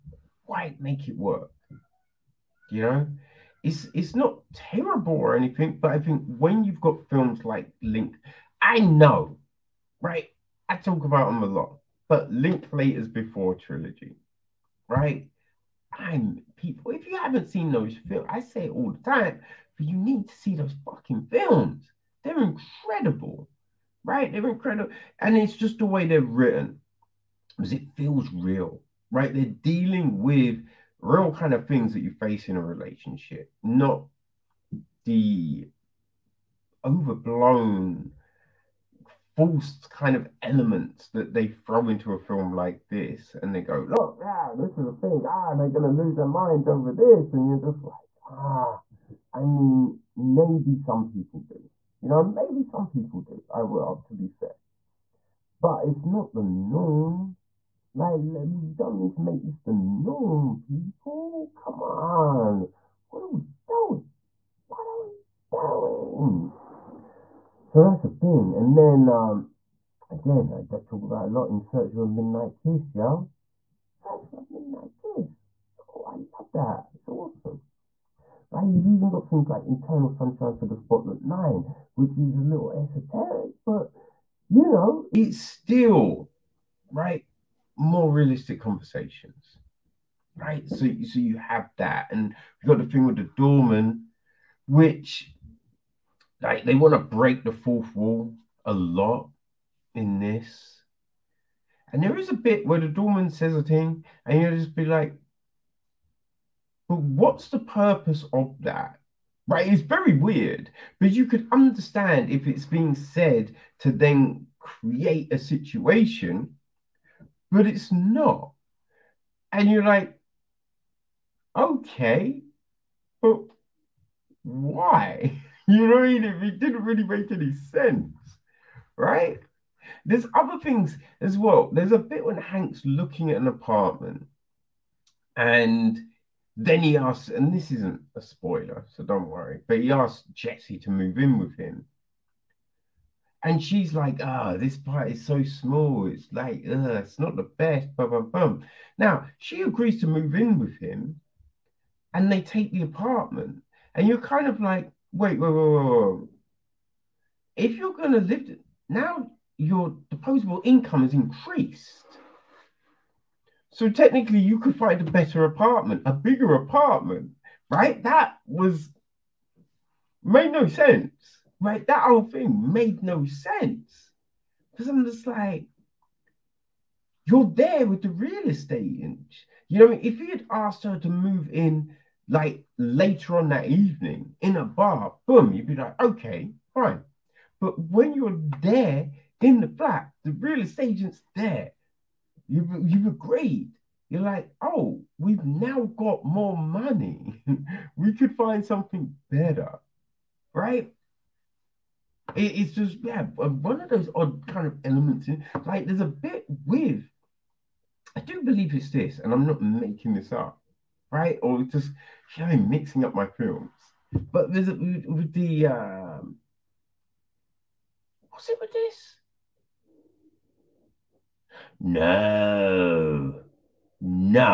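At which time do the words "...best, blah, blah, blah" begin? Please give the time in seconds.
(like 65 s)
147 s.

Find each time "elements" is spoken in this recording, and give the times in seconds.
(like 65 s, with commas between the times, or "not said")
40 s, 204 s.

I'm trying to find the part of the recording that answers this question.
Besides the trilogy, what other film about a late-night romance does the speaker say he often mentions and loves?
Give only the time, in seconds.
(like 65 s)
71 s.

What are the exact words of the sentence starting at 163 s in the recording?
So technically, you could find a better apartment, a bigger apartment, right?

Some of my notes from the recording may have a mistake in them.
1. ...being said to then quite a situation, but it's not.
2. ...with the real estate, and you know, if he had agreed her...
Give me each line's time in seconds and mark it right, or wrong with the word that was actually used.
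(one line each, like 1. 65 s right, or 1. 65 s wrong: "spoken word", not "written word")
1. 112 s wrong: "create", not "quite"
2. 177 s wrong: "asked", not "agreed".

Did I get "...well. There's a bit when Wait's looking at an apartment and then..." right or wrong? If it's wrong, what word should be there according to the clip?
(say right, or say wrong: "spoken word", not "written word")
wrong: "Hank", not "Wait".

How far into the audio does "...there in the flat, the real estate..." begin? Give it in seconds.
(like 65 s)
188 s.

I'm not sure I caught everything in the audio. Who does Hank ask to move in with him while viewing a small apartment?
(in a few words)
Jesse.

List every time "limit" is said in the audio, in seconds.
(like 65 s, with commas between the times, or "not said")
not said.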